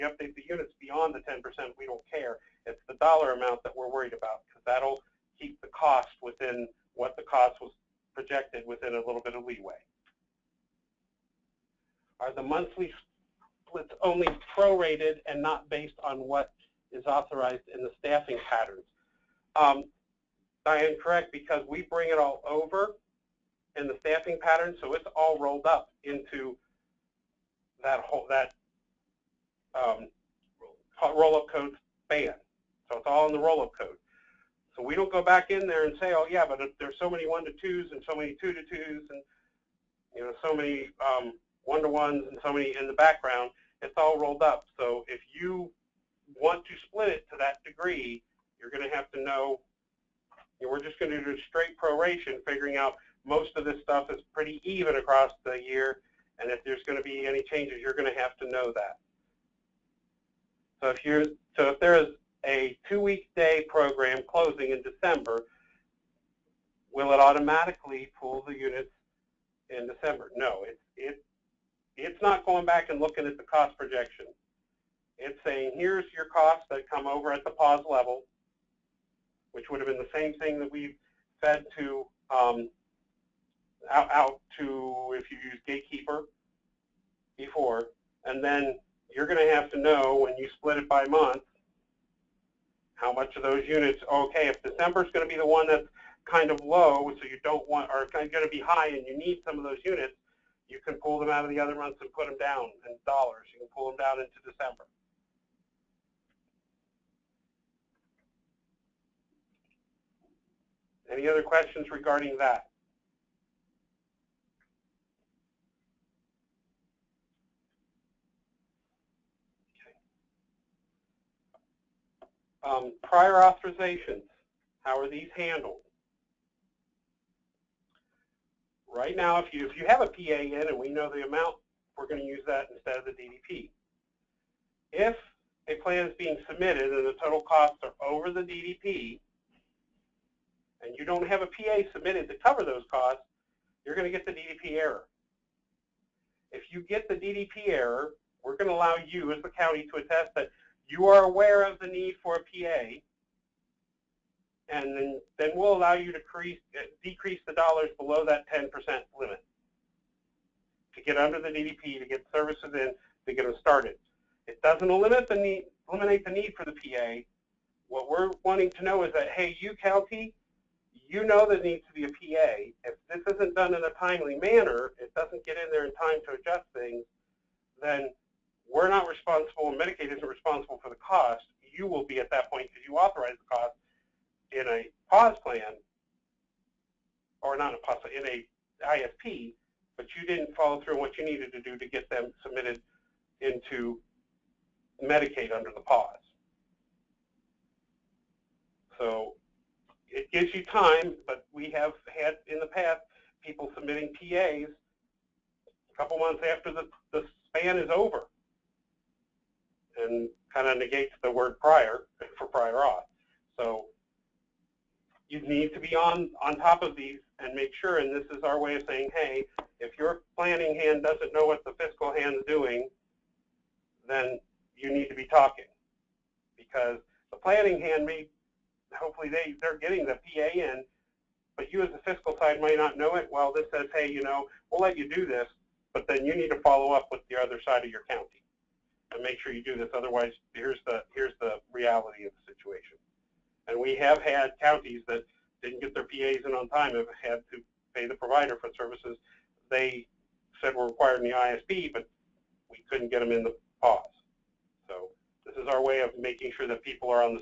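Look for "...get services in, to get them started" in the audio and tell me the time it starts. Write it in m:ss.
2:42.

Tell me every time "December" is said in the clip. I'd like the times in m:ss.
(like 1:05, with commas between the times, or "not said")
1:04, 1:09, 1:34, 1:44.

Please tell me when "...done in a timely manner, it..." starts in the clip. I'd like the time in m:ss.
2:53.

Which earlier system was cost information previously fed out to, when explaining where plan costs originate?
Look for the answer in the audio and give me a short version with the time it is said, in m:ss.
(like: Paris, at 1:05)
Gatekeeper, at 1:25.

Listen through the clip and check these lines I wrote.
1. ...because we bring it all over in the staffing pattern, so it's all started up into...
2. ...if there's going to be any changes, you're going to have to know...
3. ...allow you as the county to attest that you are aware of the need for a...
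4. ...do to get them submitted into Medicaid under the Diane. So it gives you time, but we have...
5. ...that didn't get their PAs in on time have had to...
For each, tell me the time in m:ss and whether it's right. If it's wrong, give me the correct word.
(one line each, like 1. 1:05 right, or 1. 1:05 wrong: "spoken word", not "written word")
1. 0:21 wrong: "rolled", not "started"
2. 0:56 right
3. 2:28 right
4. 3:11 wrong: "PAWS", not "Diane"
5. 4:05 right.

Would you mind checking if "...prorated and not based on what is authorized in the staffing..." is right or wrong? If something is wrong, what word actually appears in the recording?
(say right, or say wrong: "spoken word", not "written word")
right.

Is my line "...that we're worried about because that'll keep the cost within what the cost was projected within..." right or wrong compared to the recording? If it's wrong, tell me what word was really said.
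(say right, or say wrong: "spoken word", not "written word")
right.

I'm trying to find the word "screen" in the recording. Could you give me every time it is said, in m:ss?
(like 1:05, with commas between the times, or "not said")
not said.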